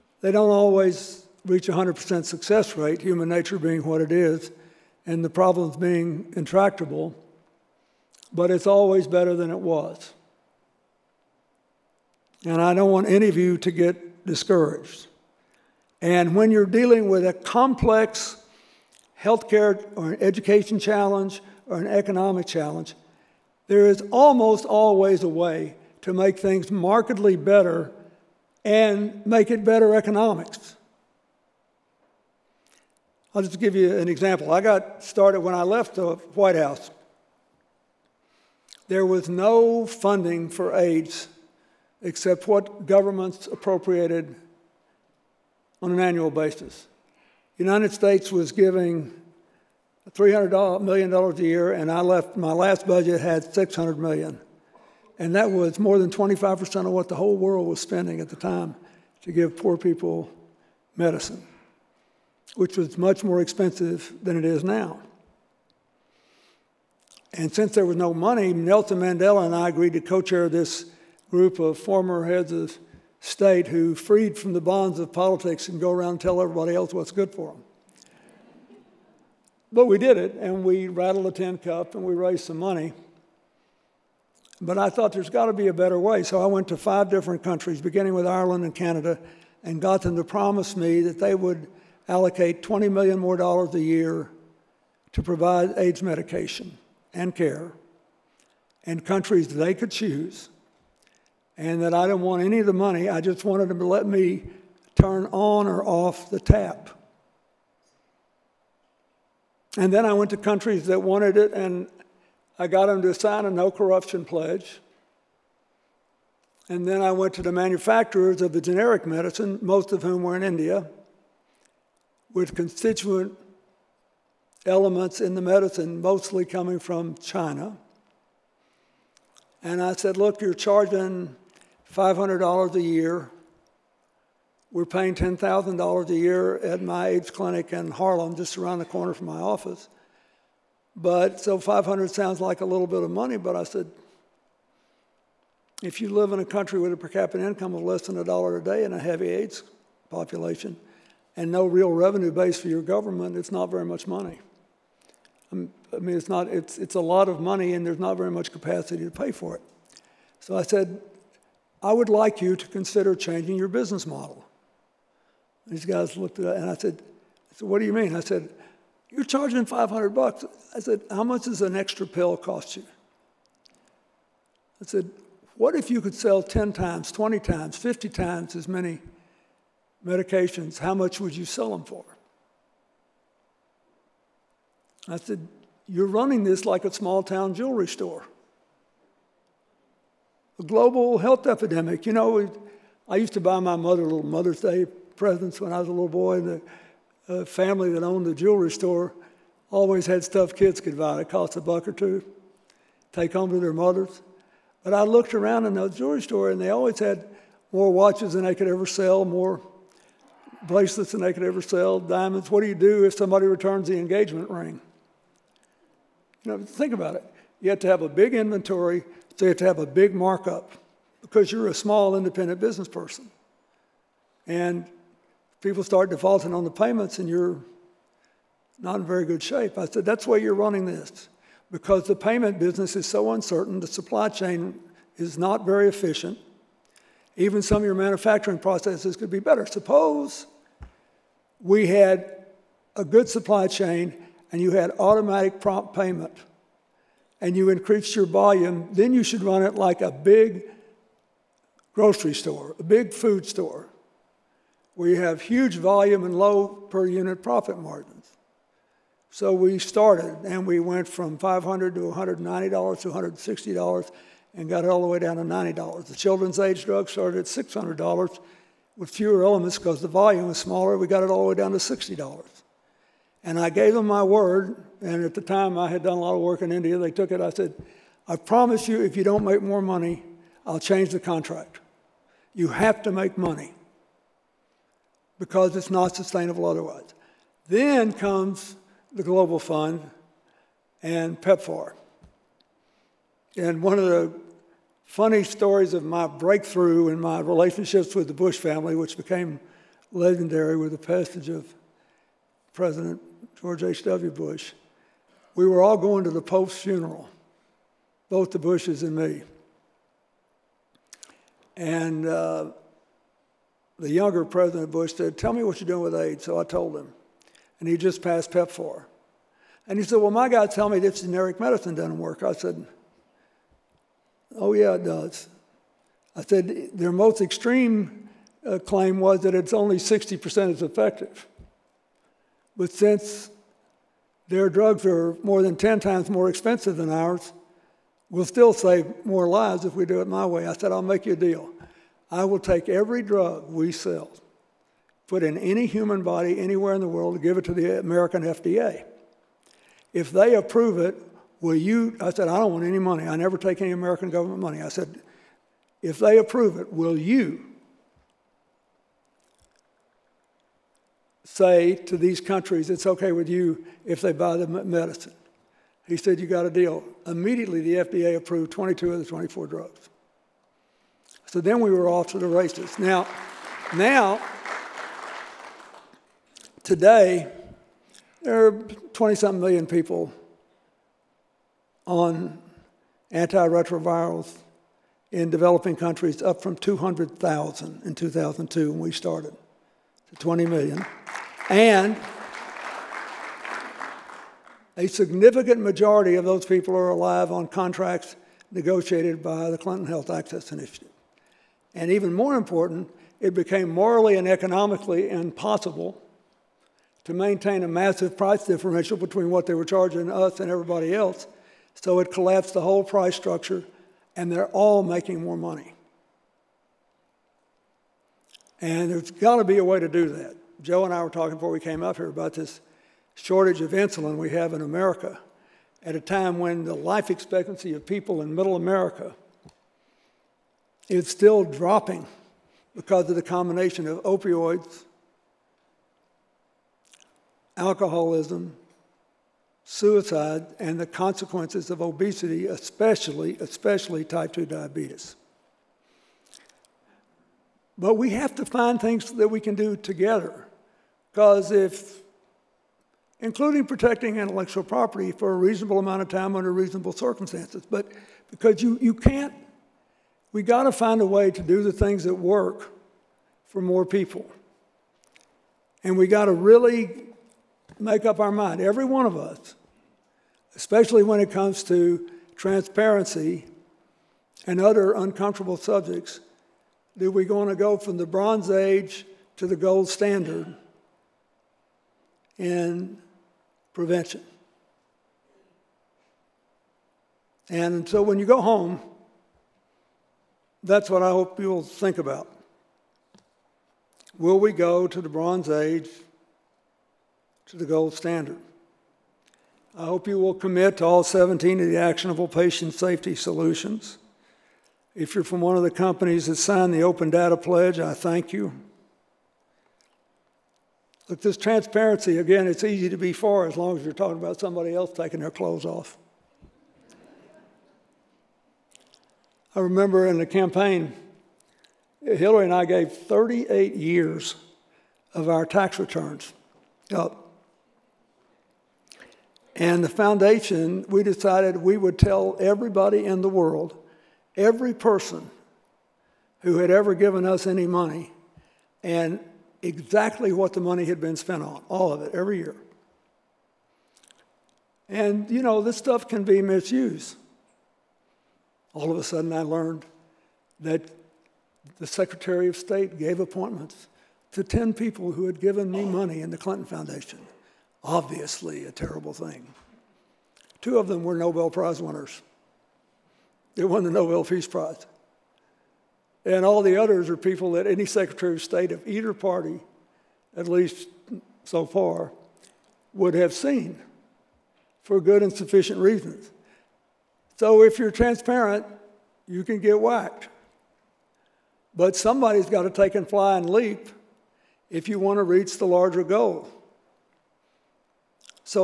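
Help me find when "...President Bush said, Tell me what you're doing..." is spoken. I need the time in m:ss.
5:14.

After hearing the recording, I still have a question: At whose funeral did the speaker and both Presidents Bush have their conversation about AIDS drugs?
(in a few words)
the Pope's.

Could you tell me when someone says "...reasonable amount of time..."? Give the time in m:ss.
7:35.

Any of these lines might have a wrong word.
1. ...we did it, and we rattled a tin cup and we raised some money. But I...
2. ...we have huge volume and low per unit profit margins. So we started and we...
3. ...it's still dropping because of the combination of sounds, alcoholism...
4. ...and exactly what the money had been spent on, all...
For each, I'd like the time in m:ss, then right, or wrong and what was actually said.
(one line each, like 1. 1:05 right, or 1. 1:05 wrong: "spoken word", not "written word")
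1. 1:19 right
2. 4:14 right
3. 7:11 wrong: "opioids", not "sounds"
4. 8:59 right.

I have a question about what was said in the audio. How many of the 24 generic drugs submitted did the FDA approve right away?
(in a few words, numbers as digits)
22.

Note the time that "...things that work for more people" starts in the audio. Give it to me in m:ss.
7:41.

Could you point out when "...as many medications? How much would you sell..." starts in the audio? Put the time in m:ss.
2:58.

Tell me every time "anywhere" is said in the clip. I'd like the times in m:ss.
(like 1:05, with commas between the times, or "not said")
5:46.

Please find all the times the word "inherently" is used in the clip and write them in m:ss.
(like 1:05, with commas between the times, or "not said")
not said.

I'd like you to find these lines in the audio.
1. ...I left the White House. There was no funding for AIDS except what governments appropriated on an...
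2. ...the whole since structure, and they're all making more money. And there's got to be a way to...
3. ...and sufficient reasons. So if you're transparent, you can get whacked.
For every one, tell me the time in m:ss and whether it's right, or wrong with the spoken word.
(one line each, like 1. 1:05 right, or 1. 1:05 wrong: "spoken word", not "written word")
1. 0:35 right
2. 6:52 wrong: "price", not "since"
3. 9:35 right.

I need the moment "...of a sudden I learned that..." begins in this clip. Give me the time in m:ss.
9:09.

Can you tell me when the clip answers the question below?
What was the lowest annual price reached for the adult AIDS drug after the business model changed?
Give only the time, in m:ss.
4:25.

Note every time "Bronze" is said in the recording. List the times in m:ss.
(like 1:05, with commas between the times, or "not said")
7:58, 8:15.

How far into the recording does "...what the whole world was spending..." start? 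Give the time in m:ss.
0:56.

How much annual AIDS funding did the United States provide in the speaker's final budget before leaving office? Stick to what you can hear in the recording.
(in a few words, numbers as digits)
$600 million.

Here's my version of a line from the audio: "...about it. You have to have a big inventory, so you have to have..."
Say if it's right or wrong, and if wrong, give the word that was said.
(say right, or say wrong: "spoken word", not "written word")
right.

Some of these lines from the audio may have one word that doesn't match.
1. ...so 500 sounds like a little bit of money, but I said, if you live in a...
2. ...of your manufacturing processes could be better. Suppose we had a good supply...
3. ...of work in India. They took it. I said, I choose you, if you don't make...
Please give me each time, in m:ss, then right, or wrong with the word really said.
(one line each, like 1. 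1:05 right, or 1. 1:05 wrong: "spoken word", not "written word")
1. 2:21 right
2. 3:57 right
3. 4:36 wrong: "promise", not "choose".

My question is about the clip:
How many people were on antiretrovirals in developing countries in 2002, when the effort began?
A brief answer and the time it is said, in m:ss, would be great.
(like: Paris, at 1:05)
200,000, at 6:26.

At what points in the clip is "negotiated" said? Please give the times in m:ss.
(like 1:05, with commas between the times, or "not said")
6:38.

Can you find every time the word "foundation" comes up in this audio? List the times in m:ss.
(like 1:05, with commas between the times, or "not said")
8:50, 9:16.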